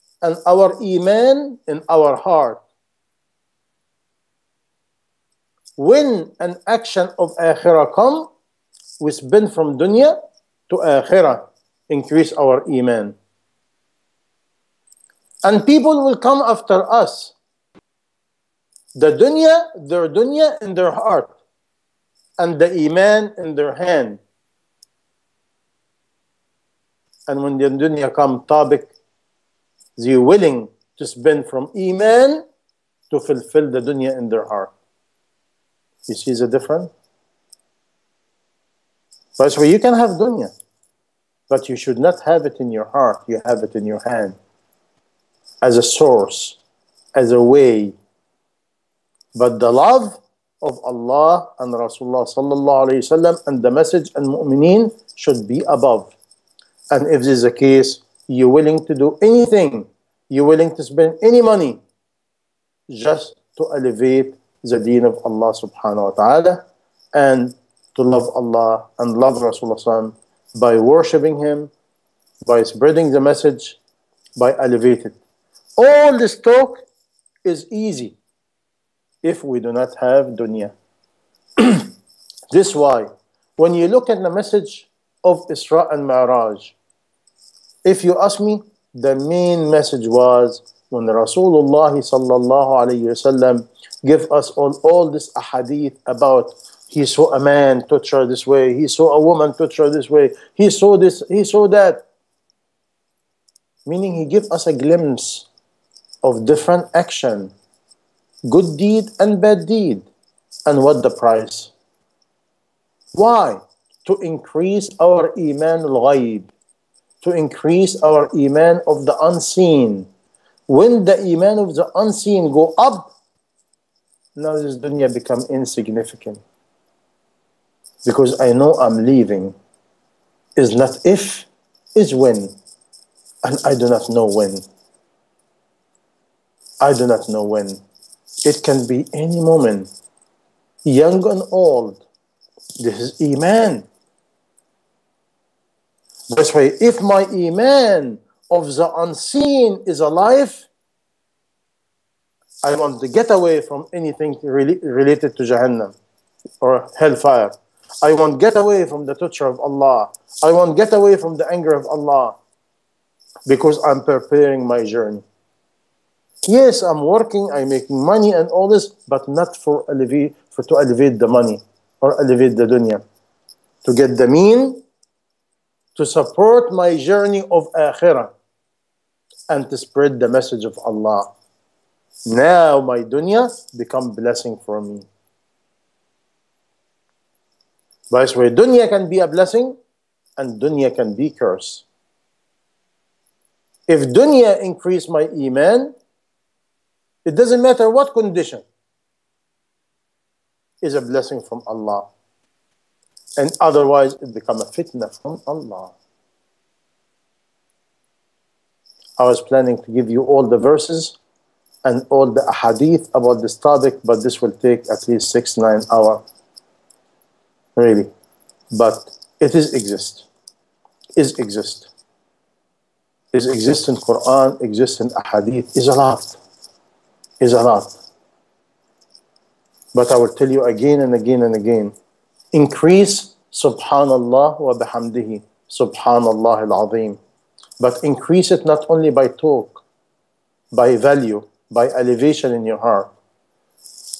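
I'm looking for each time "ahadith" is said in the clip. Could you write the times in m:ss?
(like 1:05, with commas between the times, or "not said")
1:35, 3:45.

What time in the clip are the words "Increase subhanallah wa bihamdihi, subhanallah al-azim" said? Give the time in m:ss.
3:52.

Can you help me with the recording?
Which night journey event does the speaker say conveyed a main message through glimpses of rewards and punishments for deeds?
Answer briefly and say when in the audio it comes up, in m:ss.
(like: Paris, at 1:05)
Isra and Mi'raj, at 1:25.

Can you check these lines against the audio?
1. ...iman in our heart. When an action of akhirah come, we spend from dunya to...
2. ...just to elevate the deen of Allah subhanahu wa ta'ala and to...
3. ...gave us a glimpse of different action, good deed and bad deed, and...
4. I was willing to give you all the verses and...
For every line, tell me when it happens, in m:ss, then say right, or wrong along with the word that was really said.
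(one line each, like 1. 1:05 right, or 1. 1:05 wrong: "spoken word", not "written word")
1. 0:00 right
2. 1:02 right
3. 1:44 right
4. 3:29 wrong: "planning", not "willing".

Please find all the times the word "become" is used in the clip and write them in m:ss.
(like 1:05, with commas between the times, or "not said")
2:05, 3:03, 3:24.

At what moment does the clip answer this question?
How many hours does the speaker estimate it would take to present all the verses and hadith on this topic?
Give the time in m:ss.
3:35.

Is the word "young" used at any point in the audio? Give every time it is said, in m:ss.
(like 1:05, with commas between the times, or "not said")
2:20.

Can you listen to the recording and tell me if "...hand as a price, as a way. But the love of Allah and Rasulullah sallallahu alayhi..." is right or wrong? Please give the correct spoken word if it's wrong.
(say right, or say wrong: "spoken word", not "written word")
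wrong: "source", not "price".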